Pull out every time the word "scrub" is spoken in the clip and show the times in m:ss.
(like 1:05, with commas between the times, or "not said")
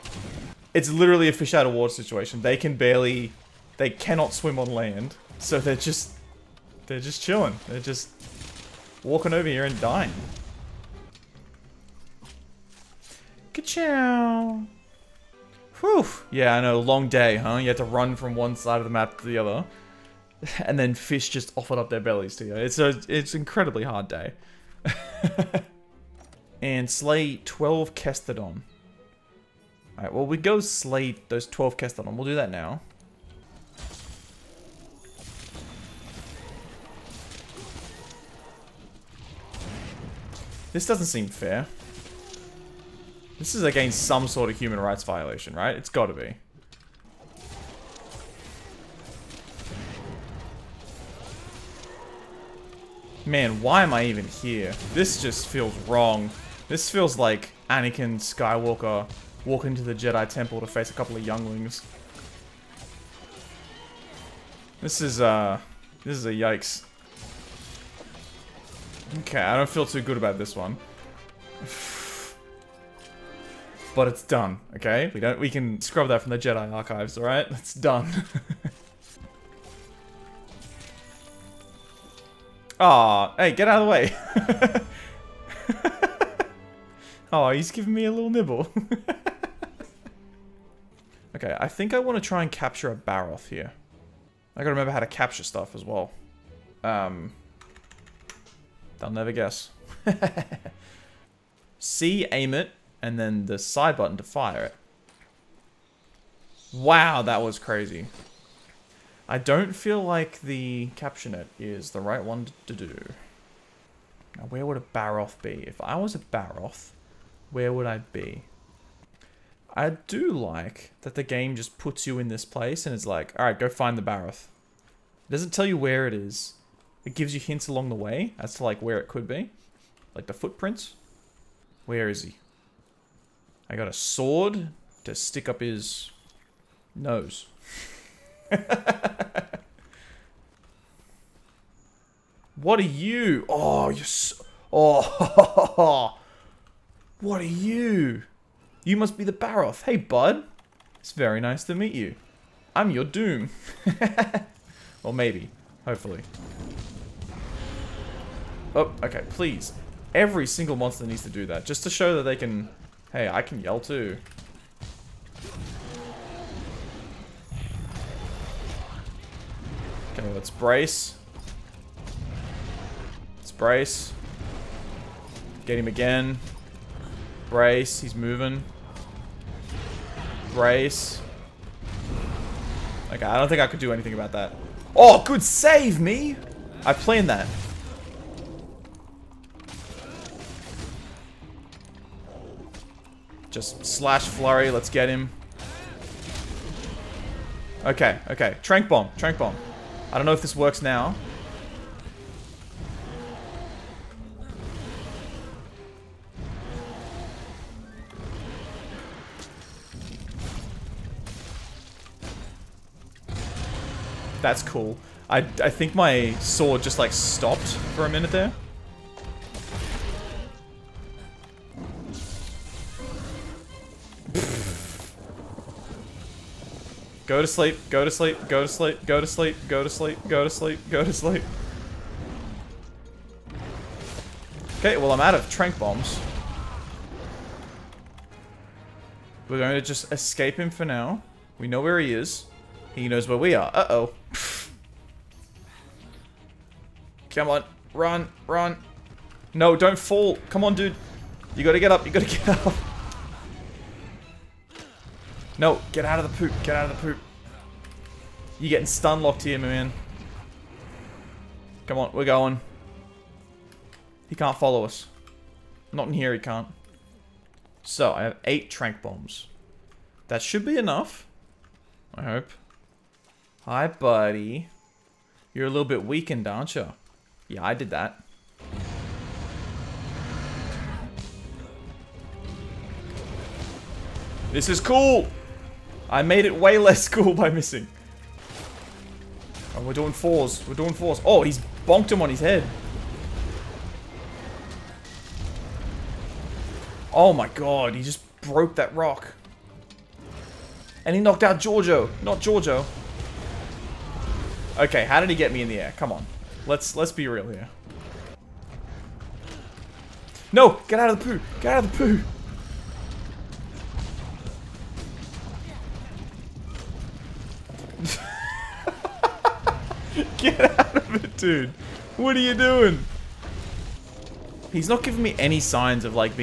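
1:15.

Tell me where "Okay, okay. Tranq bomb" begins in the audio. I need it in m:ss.
3:17.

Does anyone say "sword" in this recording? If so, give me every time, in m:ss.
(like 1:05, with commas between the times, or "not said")
2:13, 3:36.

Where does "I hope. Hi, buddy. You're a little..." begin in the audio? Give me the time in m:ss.
4:32.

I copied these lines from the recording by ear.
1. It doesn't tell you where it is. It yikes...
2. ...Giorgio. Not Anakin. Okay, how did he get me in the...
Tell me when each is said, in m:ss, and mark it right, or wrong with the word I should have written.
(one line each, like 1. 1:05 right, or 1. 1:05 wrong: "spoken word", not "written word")
1. 2:05 wrong: "gives", not "yikes"
2. 5:01 wrong: "Giorgio", not "Anakin".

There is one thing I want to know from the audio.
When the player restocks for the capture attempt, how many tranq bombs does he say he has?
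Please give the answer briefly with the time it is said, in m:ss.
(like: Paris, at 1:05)
8, at 4:28.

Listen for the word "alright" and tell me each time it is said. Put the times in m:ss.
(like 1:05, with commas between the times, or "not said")
0:29, 1:17, 2:03.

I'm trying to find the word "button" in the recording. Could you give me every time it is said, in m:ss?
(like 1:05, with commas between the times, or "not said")
1:43.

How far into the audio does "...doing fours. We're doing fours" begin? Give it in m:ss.
4:49.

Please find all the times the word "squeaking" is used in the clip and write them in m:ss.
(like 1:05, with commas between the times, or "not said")
not said.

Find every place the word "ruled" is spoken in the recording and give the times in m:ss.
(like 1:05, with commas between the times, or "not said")
not said.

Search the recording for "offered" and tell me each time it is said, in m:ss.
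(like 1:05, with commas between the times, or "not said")
0:21.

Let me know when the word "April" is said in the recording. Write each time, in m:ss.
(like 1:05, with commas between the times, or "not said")
not said.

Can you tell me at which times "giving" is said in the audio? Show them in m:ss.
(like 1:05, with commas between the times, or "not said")
1:27, 5:25.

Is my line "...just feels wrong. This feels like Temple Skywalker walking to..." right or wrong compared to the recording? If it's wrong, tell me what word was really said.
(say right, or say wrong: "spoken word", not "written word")
wrong: "Anakin", not "Temple".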